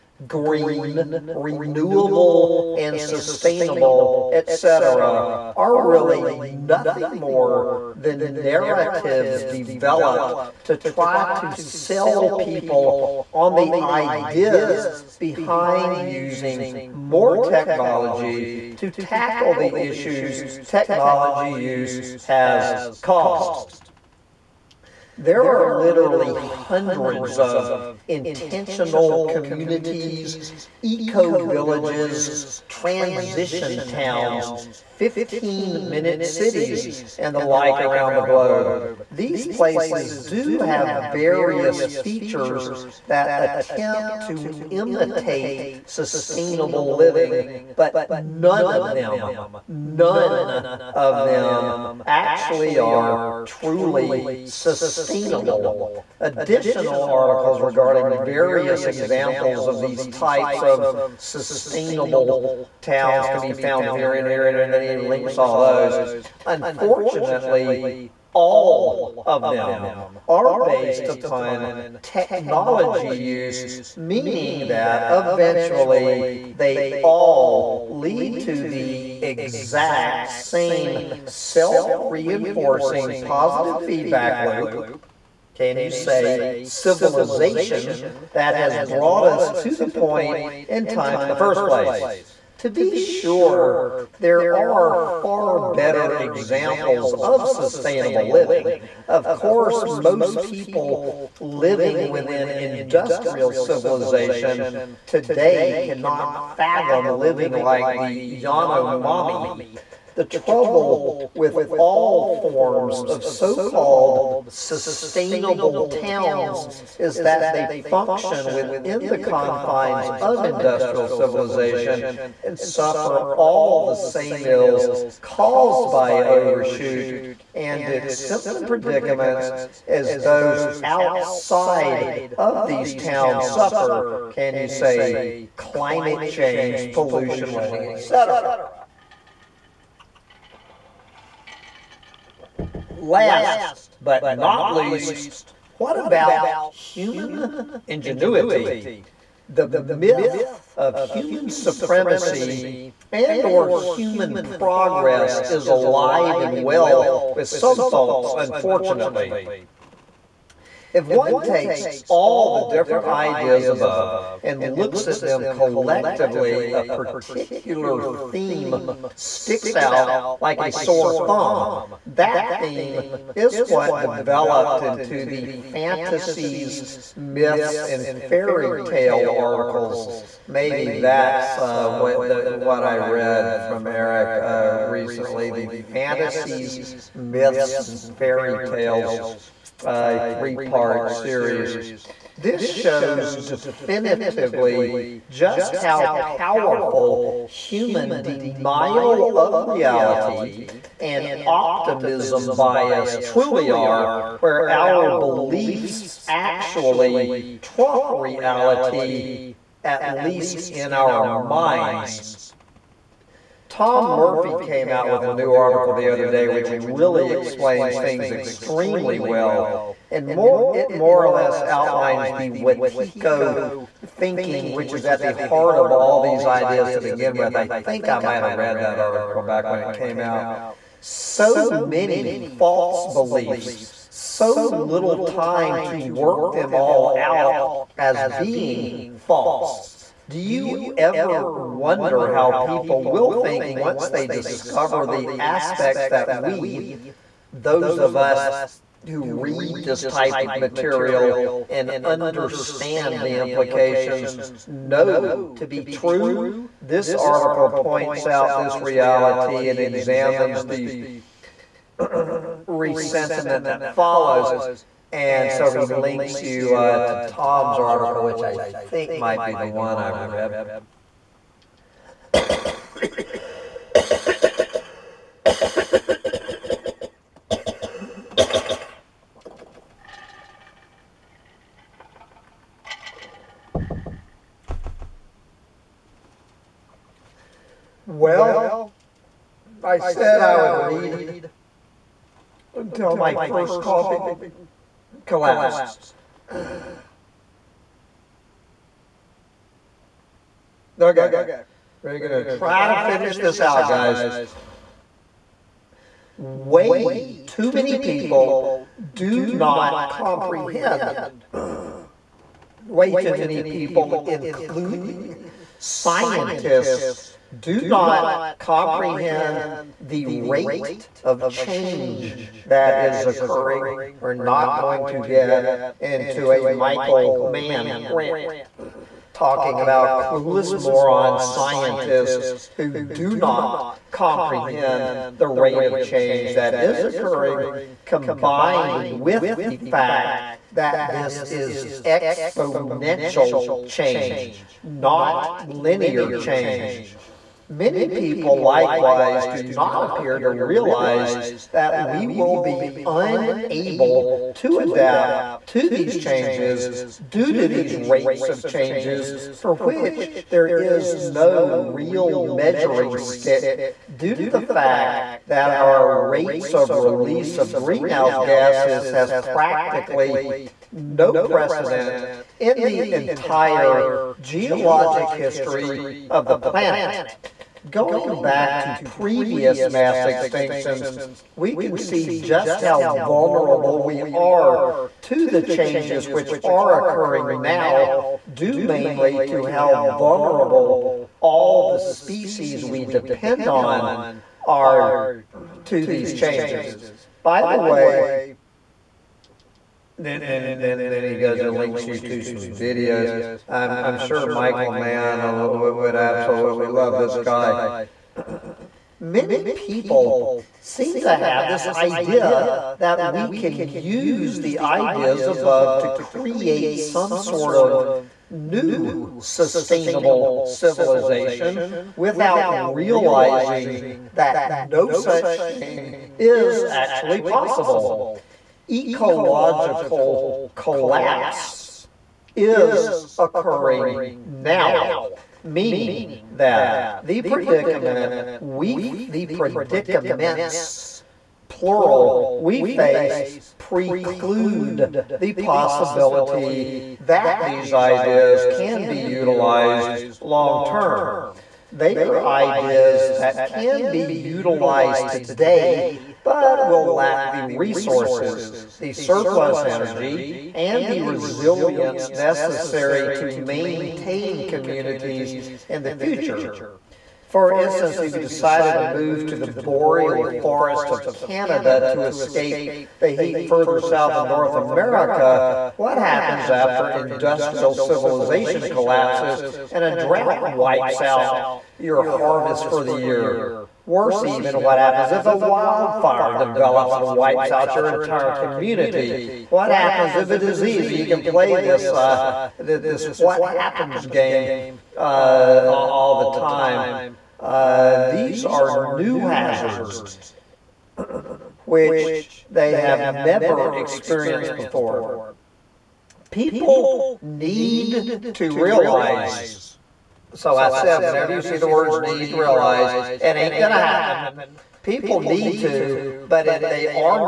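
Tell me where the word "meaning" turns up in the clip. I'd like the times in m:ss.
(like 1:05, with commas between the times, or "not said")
1:13, 7:15.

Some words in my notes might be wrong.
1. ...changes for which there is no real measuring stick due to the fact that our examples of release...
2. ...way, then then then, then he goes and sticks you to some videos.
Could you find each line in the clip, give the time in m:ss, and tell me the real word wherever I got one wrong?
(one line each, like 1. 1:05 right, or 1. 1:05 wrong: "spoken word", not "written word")
1. 5:58 wrong: "rates", not "examples"
2. 6:37 wrong: "links", not "sticks".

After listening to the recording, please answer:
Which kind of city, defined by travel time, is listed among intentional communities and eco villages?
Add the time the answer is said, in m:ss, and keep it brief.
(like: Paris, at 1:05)
15 minute cities, at 0:34.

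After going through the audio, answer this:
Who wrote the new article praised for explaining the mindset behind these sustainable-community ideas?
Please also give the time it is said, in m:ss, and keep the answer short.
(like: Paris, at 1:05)
Tom Murphy, at 3:33.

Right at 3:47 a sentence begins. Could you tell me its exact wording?
I think I might have read that article back when it came out.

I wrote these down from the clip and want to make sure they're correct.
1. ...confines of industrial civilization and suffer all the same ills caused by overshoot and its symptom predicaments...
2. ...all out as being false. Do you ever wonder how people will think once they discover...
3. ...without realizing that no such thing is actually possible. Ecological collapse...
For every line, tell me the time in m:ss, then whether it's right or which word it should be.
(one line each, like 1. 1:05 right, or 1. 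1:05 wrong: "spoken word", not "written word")
1. 1:59 right
2. 3:56 right
3. 7:02 right.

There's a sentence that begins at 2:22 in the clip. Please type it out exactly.
Last but not least, what about human ingenuity?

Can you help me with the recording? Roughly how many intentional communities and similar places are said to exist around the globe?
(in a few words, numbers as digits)
Hundreds.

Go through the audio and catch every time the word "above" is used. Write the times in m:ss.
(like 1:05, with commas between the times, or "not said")
2:43, 6:55.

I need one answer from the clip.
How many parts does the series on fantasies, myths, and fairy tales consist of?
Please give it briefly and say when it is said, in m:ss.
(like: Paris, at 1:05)
3, at 3:10.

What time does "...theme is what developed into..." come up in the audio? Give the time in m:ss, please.
2:52.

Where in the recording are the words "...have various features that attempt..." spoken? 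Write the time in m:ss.
0:40.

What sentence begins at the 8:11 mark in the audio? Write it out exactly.
You can play this uh, this what happens game uh, all the time.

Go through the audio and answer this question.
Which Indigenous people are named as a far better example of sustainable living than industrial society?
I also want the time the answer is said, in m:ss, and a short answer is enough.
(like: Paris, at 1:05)
Yanomami, at 1:48.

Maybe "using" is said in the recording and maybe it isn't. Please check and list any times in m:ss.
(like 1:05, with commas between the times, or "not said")
0:16.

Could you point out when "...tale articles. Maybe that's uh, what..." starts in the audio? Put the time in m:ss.
2:58.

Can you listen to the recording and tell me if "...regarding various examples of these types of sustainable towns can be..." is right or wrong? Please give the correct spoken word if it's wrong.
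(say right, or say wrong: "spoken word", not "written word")
right.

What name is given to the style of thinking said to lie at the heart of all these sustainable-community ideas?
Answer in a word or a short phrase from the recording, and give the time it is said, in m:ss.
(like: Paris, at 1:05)
Wétiko, at 3:42.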